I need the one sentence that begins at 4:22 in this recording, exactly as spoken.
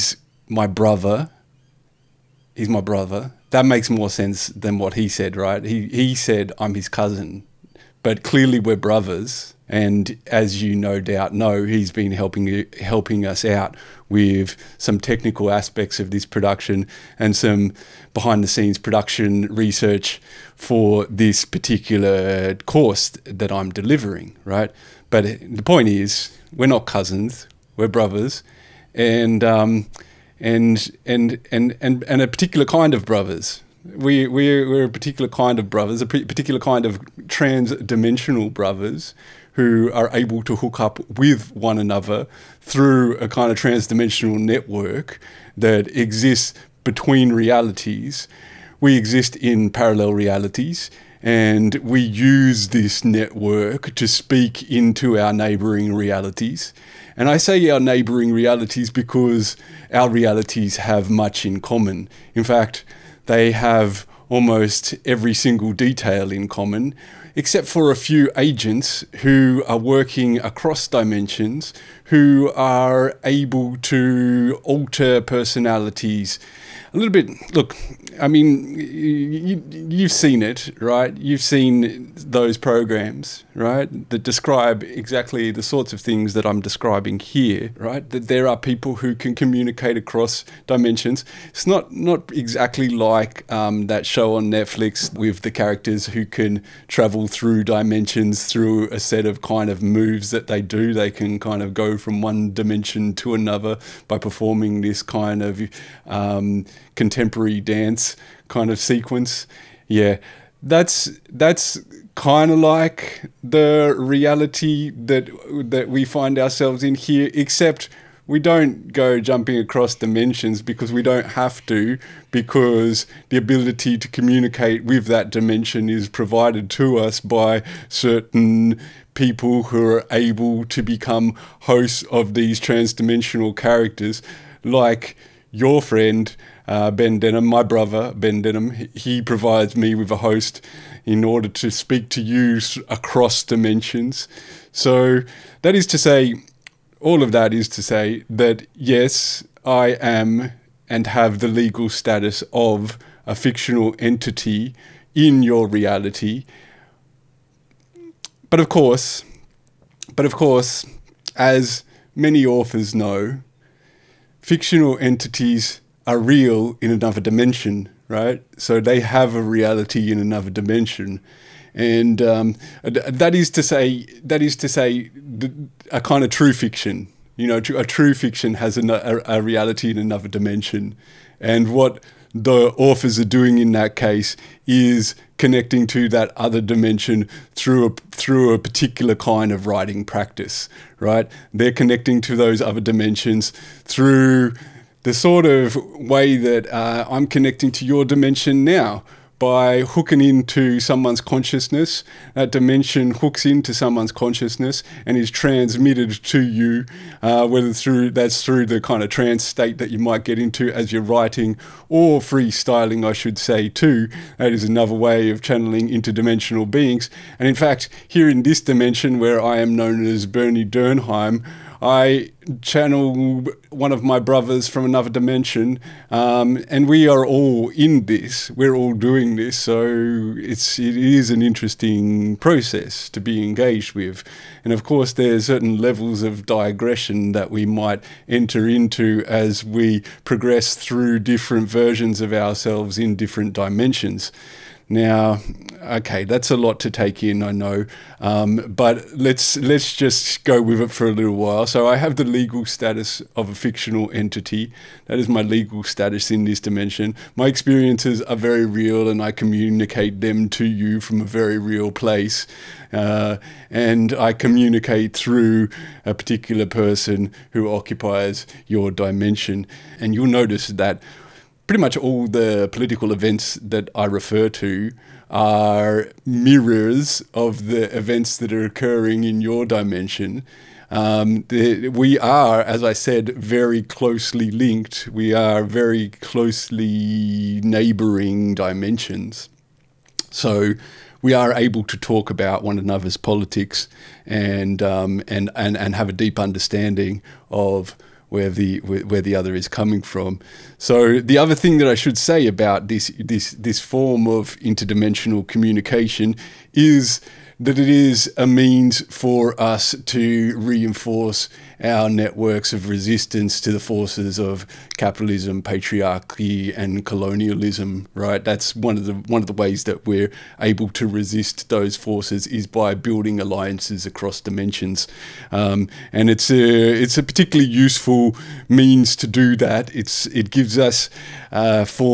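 Uh, and I communicate through a particular person who occupies your dimension.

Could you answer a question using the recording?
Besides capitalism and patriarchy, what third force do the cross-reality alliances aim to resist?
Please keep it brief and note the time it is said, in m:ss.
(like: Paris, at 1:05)
Colonialism, at 5:17.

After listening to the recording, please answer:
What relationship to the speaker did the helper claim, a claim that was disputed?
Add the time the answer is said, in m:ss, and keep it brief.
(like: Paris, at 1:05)
Cousin, at 0:06.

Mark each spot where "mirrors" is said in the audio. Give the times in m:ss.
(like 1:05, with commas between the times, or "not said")
4:36.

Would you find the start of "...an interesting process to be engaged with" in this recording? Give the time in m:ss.
3:51.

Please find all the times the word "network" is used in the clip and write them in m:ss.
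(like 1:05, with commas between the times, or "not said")
0:44, 0:53, 5:12.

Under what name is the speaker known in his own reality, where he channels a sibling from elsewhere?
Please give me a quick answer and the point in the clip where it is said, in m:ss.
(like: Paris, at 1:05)
Bernie Durnheim, at 3:40.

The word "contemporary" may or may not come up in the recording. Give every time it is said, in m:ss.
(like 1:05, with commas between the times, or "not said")
1:46.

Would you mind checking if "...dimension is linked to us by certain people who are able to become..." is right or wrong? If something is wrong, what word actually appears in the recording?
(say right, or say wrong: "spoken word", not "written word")
wrong: "provided", not "linked".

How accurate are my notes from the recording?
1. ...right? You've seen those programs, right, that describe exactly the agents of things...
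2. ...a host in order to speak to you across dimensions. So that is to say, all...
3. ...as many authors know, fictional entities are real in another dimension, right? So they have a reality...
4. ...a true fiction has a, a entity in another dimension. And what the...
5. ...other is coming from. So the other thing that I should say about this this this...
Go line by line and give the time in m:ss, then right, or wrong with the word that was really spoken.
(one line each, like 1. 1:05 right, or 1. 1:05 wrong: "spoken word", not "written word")
1. 1:20 wrong: "sorts", not "agents"
2. 2:20 right
3. 2:41 right
4. 2:57 wrong: "reality", not "entity"
5. 4:59 right.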